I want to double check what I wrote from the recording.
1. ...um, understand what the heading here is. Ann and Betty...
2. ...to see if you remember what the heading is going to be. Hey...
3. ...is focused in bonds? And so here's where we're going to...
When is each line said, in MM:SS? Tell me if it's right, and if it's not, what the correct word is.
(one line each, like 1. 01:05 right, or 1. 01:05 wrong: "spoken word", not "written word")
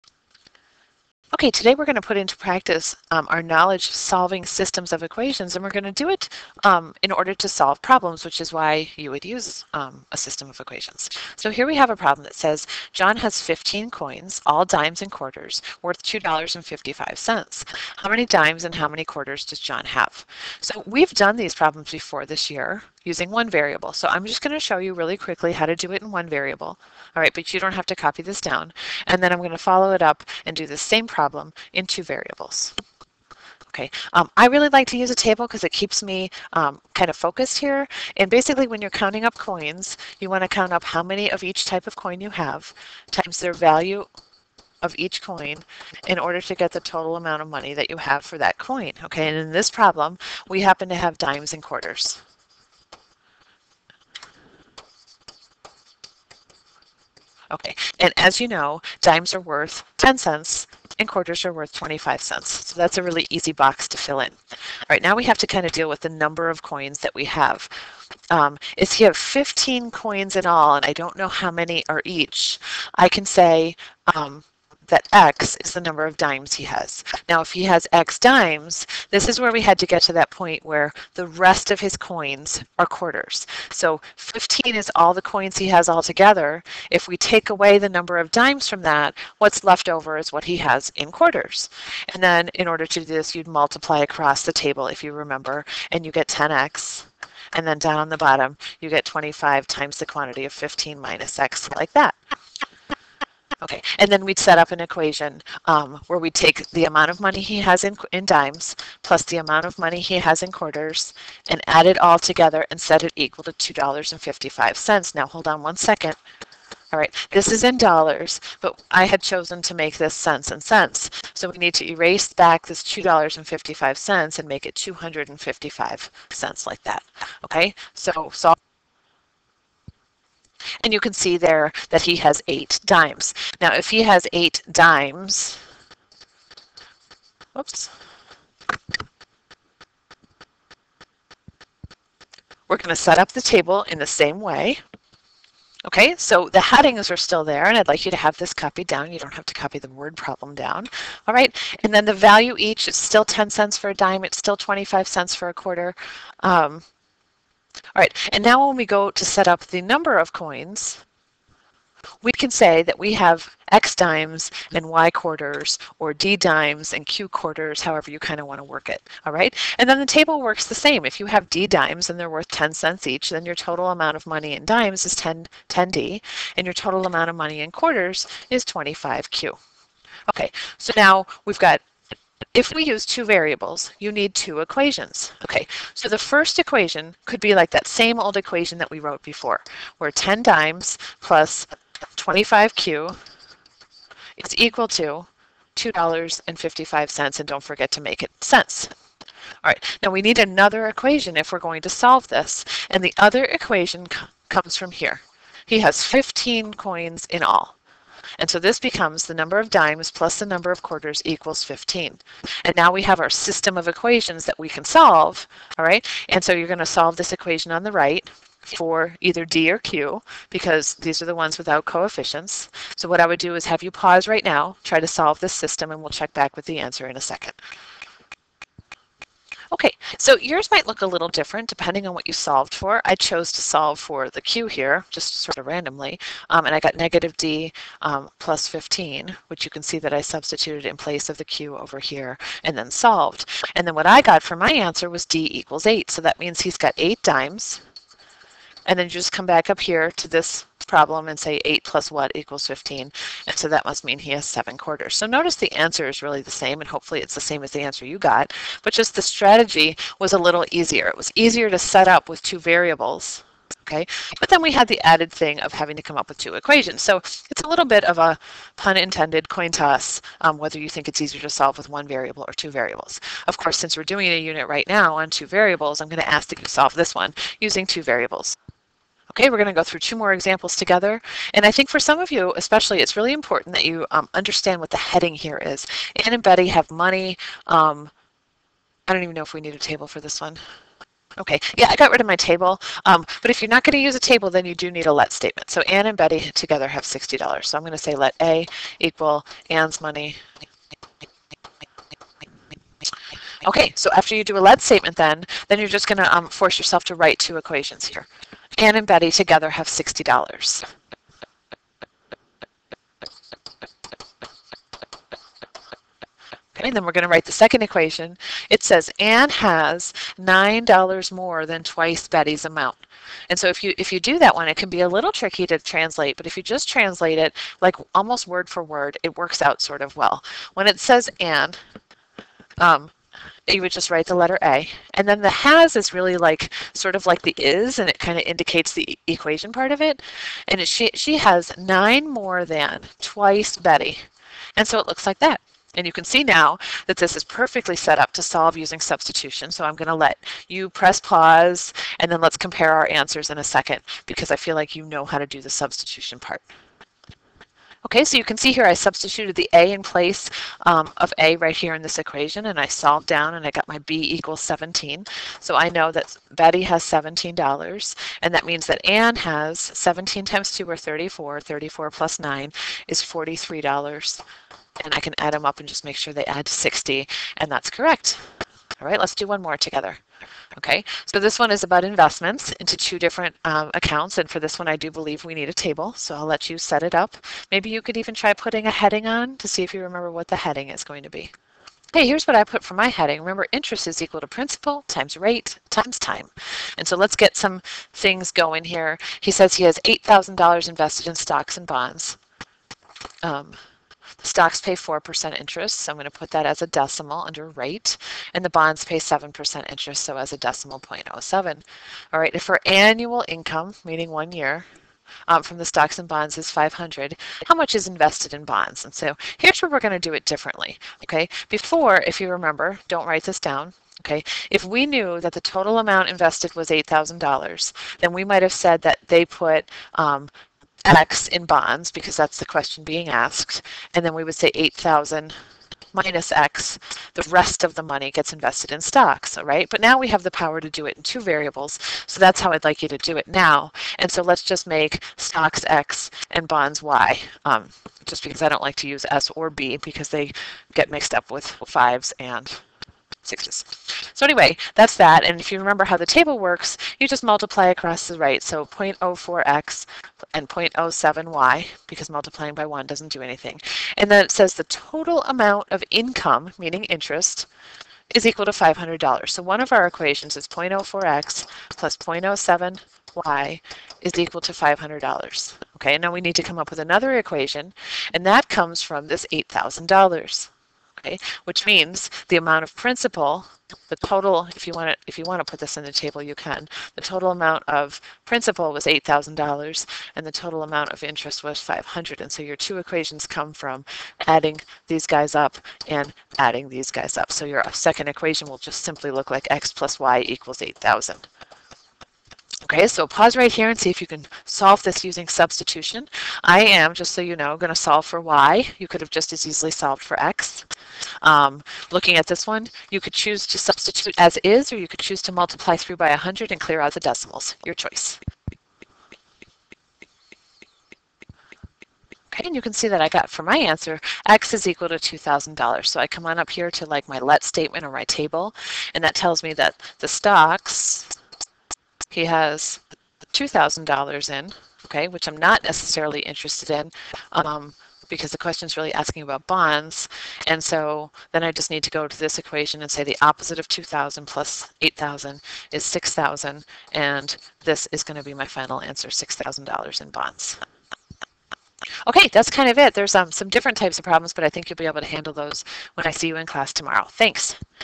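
1. 04:44 right
2. 06:29 right
3. 06:57 wrong: "invested", not "focused".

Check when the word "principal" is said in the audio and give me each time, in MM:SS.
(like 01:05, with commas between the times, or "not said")
06:34, 08:02, 08:08.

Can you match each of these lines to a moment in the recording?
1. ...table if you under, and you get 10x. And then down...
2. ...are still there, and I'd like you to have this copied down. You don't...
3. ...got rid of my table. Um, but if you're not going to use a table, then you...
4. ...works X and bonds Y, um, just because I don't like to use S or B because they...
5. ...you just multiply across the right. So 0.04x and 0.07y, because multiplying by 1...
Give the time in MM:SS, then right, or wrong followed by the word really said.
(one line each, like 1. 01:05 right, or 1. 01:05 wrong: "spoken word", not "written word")
1. 01:34 wrong: "remember", not "under"
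2. 02:27 right
3. 04:51 right
4. 07:25 wrong: "stocks", not "works"
5. 07:37 right.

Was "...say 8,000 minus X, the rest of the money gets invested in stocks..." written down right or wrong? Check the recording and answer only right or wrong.
right.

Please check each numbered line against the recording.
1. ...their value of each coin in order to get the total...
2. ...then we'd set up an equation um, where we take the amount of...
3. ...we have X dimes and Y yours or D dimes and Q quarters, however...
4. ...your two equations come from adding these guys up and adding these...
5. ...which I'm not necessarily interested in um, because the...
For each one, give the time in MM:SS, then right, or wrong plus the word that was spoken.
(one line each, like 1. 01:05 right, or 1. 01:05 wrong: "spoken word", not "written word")
1. 00:43 right
2. 01:44 right
3. 02:42 wrong: "quarters", not "yours"
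4. 08:12 right
5. 08:55 right.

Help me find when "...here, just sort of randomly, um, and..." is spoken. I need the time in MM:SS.
03:54.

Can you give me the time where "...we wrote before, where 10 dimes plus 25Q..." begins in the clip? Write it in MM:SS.
03:08.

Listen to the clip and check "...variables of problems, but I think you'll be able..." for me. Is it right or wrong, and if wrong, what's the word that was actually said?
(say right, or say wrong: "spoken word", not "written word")
wrong: "types", not "variables".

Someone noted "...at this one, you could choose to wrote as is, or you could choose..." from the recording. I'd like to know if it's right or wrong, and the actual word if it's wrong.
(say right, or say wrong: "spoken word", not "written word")
wrong: "substitute", not "wrote".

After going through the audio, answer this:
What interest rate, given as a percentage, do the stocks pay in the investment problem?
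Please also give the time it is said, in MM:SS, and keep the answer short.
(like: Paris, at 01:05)
4%, at 06:44.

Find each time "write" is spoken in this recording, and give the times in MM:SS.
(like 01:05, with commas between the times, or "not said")
05:07, 05:17, 05:34, 07:03.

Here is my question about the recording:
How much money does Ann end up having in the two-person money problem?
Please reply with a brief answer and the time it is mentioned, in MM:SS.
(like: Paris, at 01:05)
$43, at 06:13.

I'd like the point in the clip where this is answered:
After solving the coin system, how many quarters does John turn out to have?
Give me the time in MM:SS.
04:14.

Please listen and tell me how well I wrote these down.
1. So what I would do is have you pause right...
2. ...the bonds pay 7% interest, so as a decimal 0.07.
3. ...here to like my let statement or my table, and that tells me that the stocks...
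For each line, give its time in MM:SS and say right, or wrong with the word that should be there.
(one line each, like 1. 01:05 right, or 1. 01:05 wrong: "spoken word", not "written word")
1. 03:42 right
2. 06:48 right
3. 08:46 right.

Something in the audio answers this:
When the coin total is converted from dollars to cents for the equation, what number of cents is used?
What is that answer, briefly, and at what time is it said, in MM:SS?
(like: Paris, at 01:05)
255, at 02:04.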